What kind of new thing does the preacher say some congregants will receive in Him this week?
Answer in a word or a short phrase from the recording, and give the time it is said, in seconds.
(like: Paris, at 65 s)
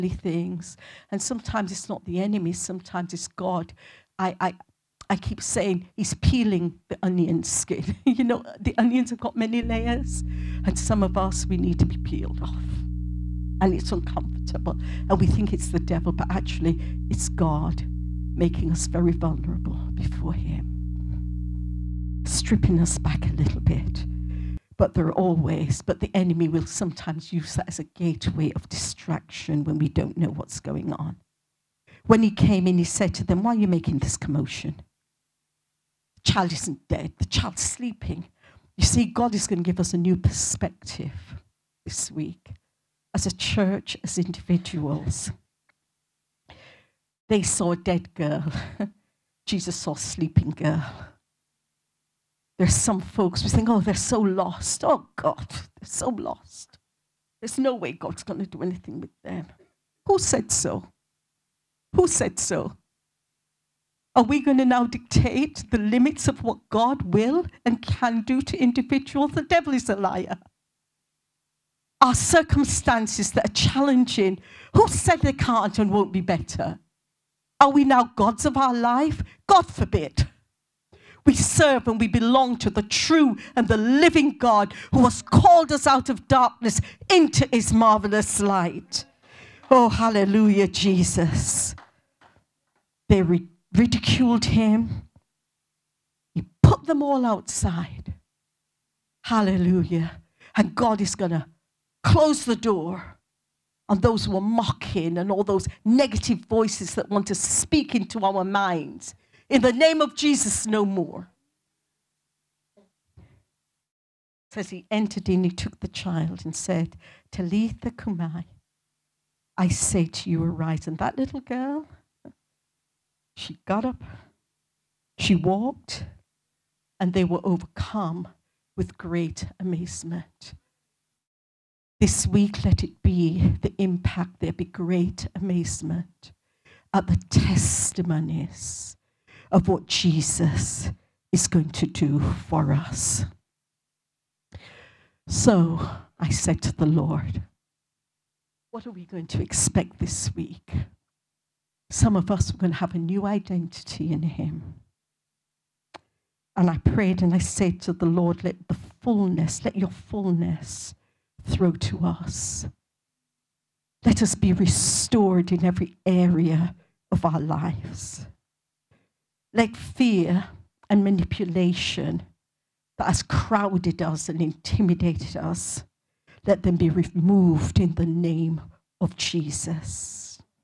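identity, at 152 s.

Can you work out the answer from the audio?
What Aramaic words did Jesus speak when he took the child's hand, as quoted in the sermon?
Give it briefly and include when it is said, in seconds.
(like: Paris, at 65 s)
Talitha cumi, at 117 s.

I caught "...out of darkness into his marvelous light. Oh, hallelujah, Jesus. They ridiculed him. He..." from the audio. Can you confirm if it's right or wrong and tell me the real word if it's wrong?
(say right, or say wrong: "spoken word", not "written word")
right.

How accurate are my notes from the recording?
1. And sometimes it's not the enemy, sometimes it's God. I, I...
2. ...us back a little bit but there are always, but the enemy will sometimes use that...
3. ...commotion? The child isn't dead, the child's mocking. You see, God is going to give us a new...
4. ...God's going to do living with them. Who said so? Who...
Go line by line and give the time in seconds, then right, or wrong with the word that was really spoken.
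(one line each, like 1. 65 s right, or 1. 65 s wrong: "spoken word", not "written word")
1. 1 s right
2. 22 s right
3. 34 s wrong: "sleeping", not "mocking"
4. 57 s wrong: "anything", not "living".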